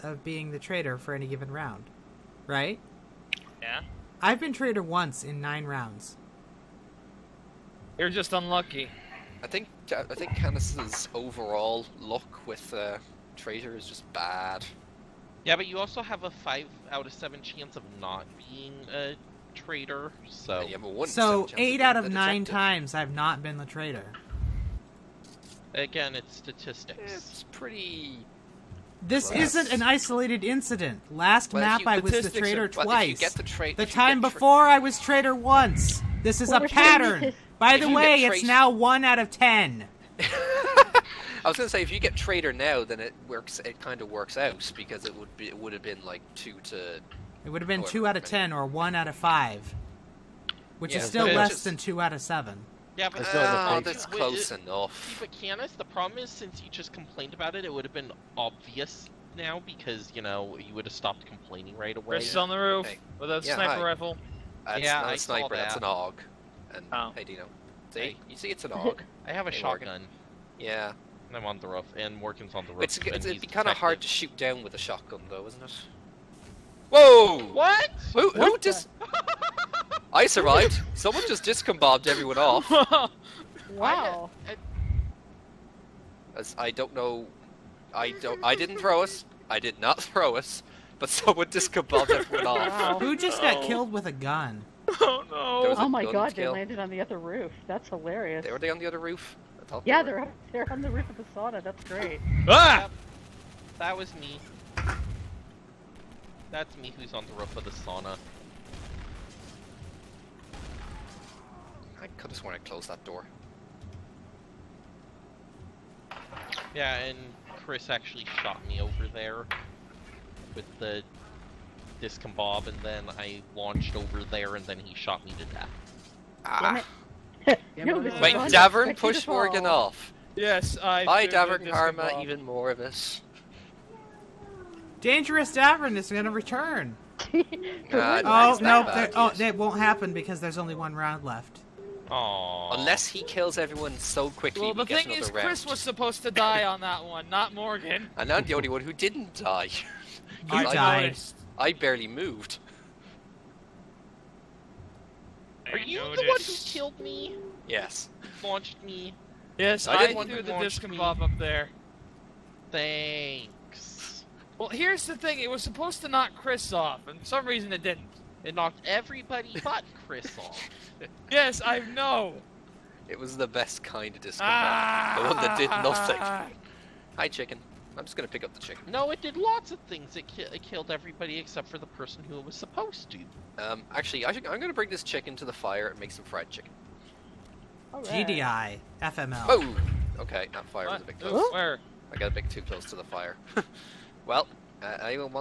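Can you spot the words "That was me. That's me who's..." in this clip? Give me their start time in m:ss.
1:43.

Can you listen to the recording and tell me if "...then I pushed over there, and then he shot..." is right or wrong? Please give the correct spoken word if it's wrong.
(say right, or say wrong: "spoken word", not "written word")
wrong: "launched", not "pushed".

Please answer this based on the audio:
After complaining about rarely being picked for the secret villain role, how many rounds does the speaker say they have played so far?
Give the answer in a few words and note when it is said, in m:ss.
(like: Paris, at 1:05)
9, at 0:05.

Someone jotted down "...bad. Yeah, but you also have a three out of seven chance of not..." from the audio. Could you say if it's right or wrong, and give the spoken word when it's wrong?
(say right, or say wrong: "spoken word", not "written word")
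wrong: "five", not "three".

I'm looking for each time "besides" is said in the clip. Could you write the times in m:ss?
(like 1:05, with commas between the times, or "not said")
not said.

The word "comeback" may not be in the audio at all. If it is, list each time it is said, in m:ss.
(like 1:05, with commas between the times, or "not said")
not said.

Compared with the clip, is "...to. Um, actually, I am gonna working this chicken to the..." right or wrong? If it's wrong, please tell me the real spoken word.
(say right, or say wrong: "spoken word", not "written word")
wrong: "bring", not "working".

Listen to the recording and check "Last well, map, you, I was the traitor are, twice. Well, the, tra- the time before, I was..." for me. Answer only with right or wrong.
right.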